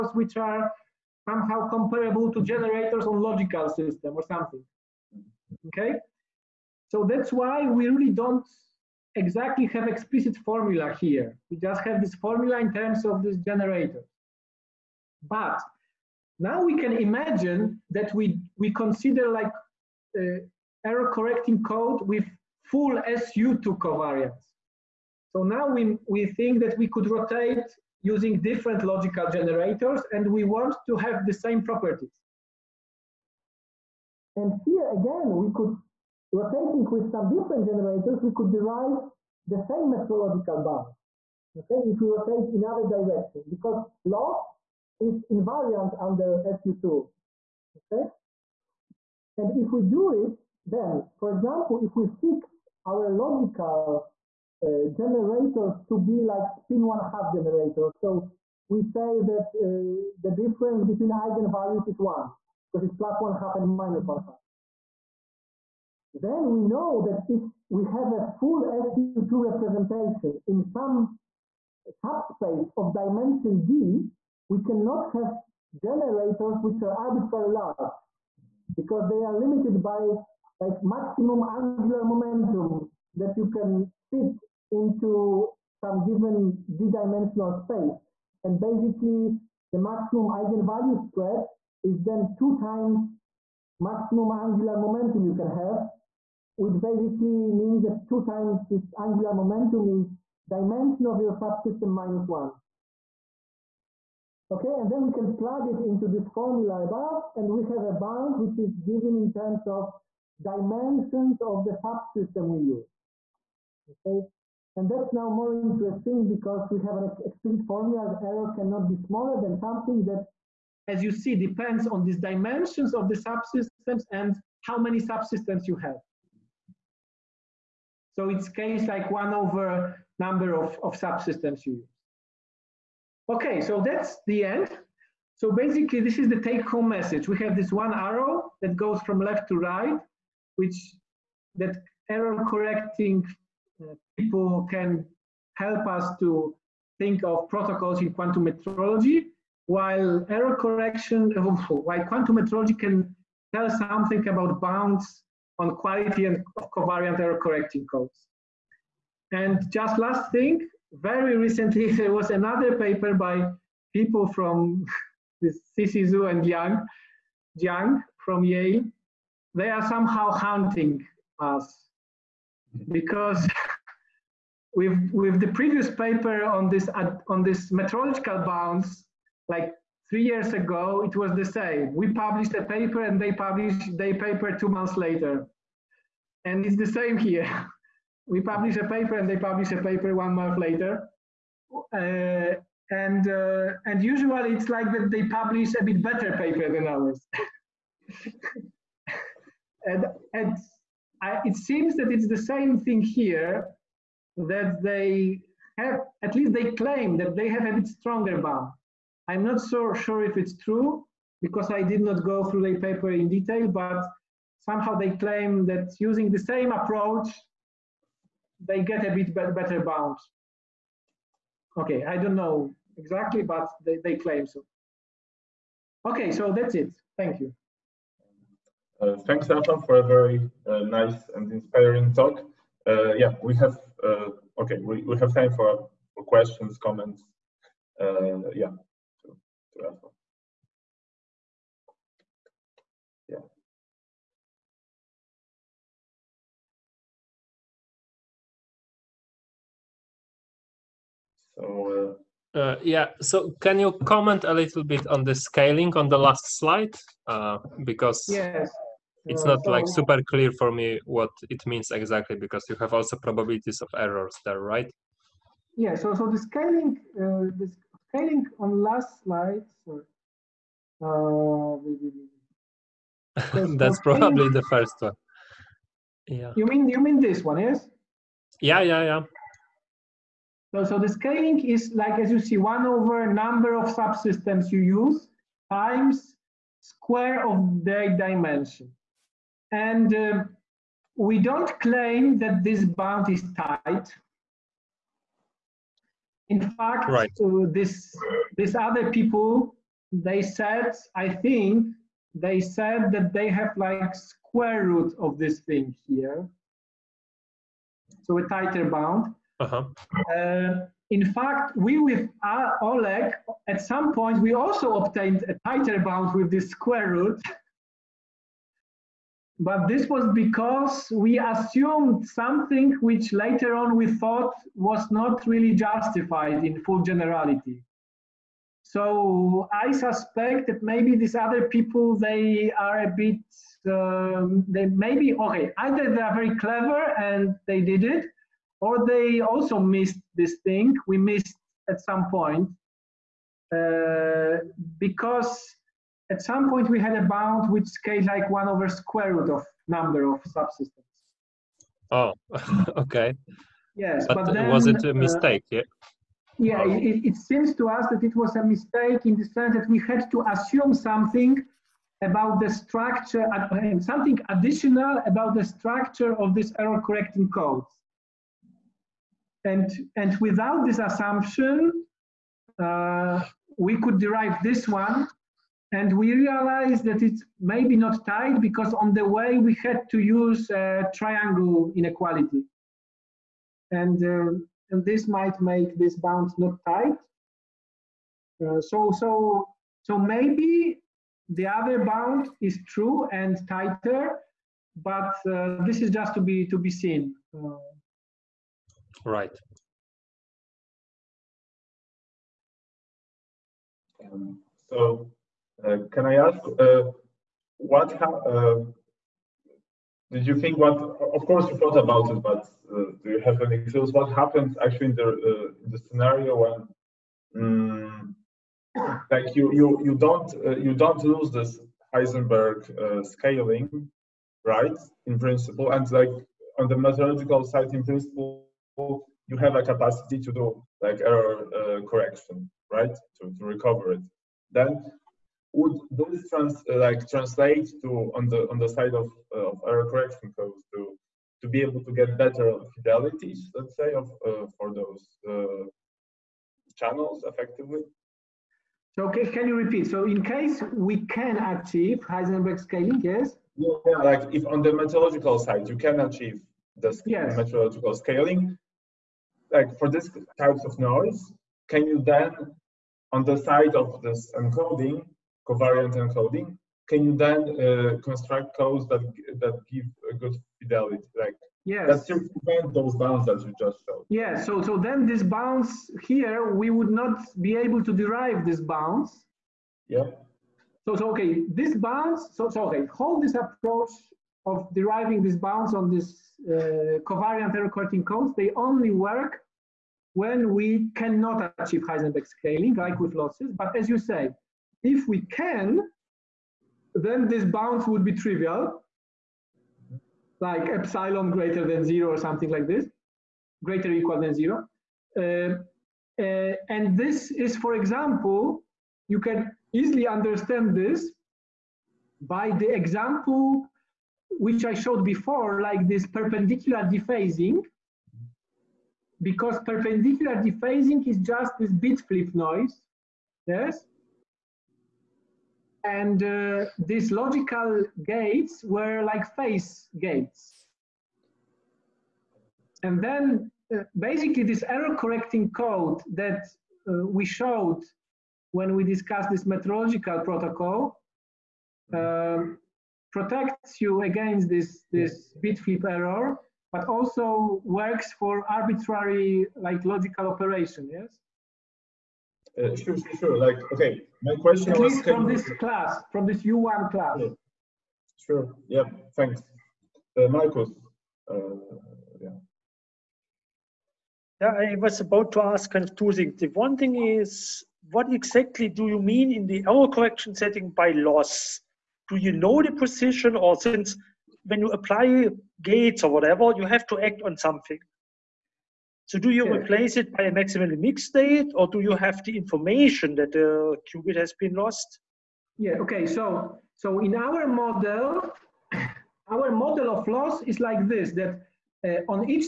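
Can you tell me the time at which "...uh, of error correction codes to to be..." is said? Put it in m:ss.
7:19.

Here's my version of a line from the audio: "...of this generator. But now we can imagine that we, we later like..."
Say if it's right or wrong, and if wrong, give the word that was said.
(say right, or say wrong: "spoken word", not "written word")
wrong: "consider", not "later".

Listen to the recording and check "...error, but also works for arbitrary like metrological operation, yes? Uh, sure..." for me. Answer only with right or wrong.
wrong.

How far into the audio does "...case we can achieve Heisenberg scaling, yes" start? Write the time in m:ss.
7:30.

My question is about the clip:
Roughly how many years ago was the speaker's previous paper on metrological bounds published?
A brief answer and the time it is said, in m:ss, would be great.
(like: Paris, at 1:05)
3 years, at 3:00.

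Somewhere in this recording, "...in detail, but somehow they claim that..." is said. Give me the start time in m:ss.
3:33.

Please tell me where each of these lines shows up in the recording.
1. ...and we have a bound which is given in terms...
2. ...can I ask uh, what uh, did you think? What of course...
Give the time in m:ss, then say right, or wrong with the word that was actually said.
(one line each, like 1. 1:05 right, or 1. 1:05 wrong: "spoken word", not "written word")
1. 1:47 right
2. 6:46 right.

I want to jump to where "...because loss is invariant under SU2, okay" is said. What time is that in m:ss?
0:43.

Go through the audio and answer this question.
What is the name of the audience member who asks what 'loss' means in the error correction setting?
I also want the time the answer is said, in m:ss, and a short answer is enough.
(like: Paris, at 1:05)
Marcus, at 9:20.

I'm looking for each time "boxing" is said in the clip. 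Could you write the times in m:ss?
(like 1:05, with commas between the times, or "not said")
not said.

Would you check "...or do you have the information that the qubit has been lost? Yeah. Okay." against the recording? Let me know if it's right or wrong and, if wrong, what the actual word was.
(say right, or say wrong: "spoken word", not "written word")
right.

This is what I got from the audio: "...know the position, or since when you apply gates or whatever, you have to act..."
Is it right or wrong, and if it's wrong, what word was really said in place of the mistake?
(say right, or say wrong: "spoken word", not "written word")
right.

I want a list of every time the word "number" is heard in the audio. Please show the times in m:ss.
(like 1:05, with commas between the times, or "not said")
2:10, 4:43, 5:49.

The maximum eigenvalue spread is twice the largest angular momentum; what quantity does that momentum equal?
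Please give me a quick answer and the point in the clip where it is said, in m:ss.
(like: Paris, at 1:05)
dimension of your subsystem minus one, at 1:40.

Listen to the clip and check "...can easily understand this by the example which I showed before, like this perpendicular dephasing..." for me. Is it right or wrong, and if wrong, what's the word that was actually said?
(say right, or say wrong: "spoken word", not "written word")
right.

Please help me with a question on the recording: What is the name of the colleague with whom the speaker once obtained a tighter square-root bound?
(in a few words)
Olek.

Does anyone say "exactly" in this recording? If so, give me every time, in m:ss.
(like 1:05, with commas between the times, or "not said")
0:09, 3:42, 4:21, 9:28.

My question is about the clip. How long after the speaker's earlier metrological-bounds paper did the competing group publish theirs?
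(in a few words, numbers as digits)
2 months.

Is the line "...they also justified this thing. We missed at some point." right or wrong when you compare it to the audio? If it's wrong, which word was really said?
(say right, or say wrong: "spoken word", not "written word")
wrong: "missed", not "justified".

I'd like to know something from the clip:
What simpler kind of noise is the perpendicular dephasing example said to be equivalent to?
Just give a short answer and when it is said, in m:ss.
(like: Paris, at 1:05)
bit flip noise, at 8:41.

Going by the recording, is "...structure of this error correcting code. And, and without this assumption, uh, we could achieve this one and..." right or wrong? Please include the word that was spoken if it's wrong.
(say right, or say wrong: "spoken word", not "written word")
wrong: "derive", not "achieve".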